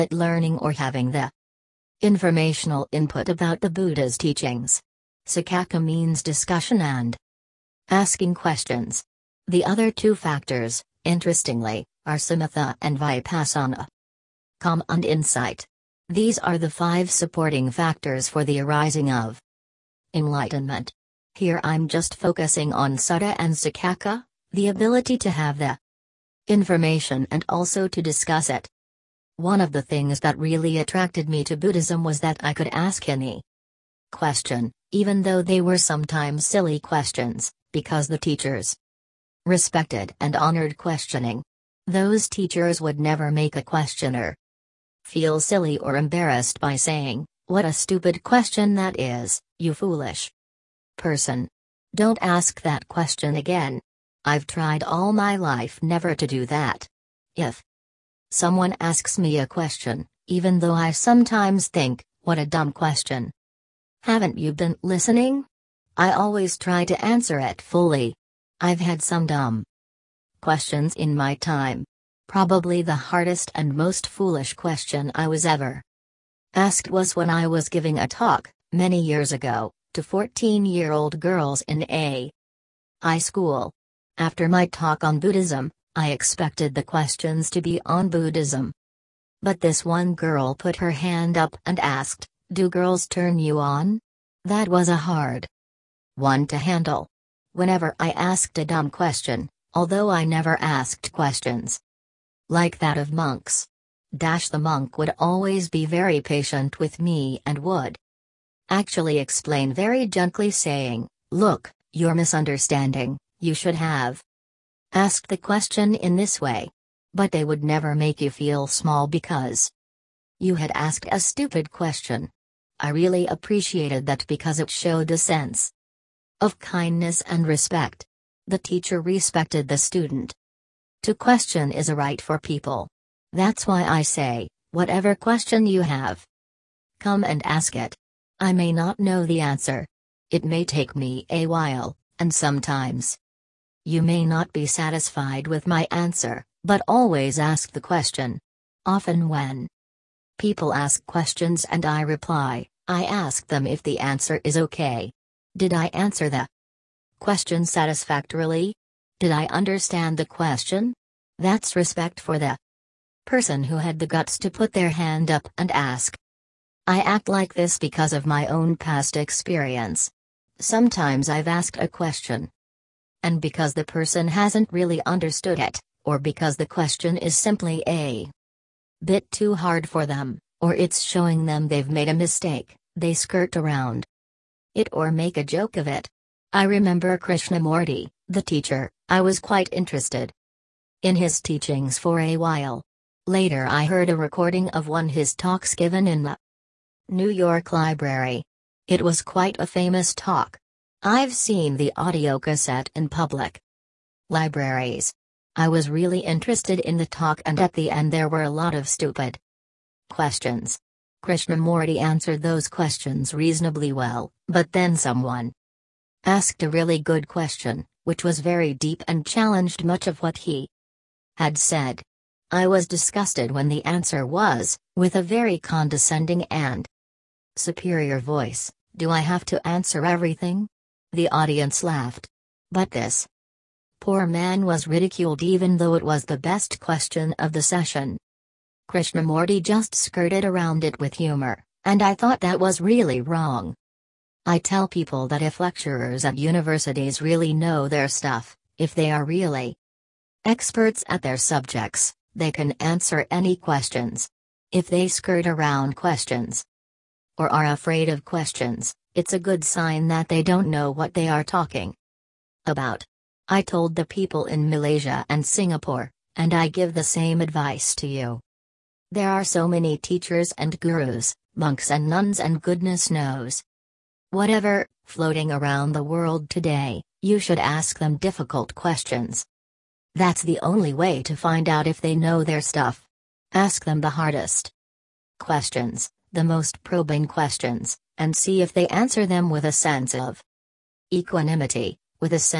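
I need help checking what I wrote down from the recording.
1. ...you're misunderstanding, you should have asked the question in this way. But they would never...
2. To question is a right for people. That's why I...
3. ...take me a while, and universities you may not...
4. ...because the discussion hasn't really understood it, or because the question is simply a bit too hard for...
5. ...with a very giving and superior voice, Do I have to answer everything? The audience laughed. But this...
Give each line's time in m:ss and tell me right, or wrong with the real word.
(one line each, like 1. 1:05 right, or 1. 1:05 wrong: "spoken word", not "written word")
1. 1:51 right
2. 2:11 right
3. 2:20 wrong: "sometimes", not "universities"
4. 2:53 wrong: "person", not "discussion"
5. 3:44 wrong: "condescending", not "giving".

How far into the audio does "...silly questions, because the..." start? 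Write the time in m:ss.
0:36.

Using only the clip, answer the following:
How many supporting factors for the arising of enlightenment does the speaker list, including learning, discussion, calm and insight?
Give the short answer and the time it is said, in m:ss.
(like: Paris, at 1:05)
5, at 0:16.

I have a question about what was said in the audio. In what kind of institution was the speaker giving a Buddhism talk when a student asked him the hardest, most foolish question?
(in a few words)
High school.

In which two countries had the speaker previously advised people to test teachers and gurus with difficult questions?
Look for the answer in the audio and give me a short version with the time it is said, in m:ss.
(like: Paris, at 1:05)
Malaysia and Singapore, at 4:24.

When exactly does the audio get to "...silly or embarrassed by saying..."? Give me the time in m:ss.
0:45.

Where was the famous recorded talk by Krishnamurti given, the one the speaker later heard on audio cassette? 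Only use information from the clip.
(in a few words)
New York Library.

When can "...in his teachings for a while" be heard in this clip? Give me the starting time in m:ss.
3:11.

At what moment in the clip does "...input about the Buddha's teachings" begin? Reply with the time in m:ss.
0:02.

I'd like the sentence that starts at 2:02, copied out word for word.
I really appreciated that because it showed a sense of kindness and respect.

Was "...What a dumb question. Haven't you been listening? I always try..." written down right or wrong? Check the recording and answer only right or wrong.
right.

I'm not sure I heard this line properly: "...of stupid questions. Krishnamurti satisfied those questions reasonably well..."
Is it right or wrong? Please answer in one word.
wrong.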